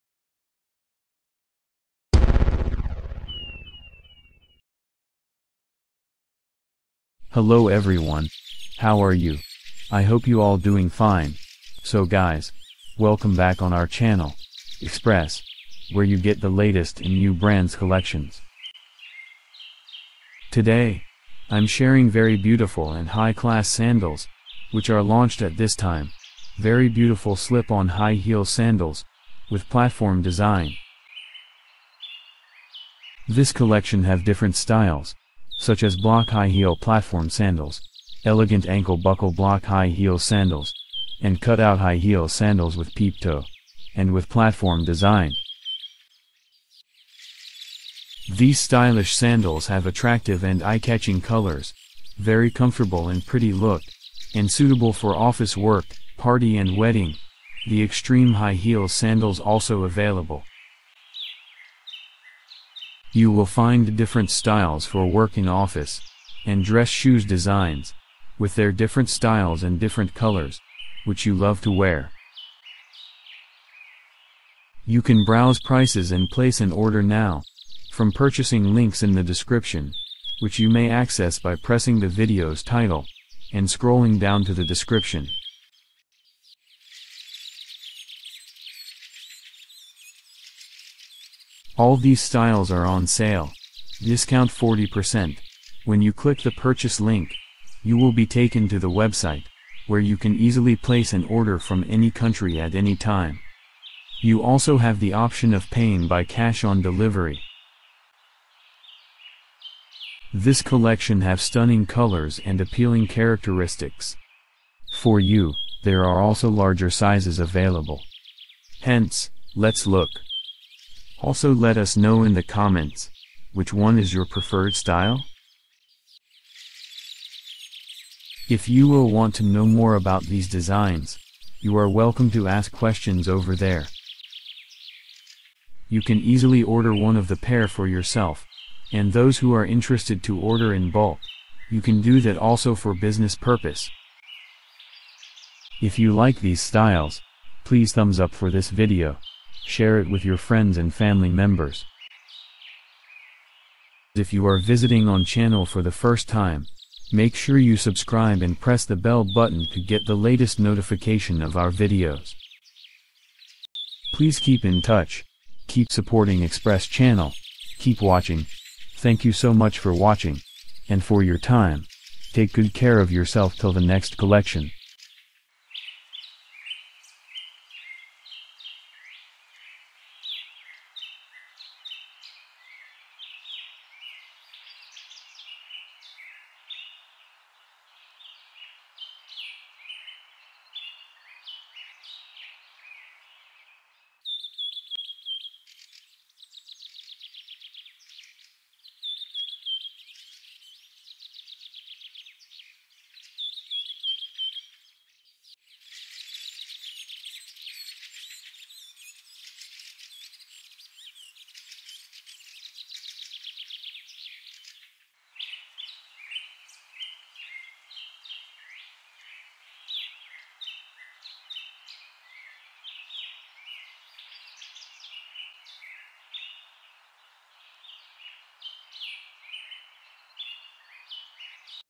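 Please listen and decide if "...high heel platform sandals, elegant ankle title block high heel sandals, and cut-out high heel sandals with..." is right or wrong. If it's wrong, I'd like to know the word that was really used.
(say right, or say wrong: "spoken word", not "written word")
wrong: "buckle", not "title".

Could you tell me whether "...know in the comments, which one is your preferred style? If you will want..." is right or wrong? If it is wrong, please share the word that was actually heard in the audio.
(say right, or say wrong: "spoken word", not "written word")
right.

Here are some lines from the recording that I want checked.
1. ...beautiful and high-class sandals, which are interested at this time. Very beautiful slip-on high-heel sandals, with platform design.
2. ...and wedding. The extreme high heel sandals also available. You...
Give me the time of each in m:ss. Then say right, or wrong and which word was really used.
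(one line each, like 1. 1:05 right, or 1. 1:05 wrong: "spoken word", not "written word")
1. 0:22 wrong: "launched", not "interested"
2. 0:56 right.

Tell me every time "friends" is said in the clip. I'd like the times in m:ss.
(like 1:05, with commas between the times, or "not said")
2:30.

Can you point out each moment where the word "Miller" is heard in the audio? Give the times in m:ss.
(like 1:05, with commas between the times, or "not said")
not said.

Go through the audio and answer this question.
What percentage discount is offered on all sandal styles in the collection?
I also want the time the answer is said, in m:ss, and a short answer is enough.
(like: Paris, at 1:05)
40%, at 1:34.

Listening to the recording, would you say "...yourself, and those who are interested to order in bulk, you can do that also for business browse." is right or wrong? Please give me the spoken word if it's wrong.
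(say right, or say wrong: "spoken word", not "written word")
wrong: "purpose", not "browse".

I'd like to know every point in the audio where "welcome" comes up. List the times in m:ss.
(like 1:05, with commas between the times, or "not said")
0:12, 2:11.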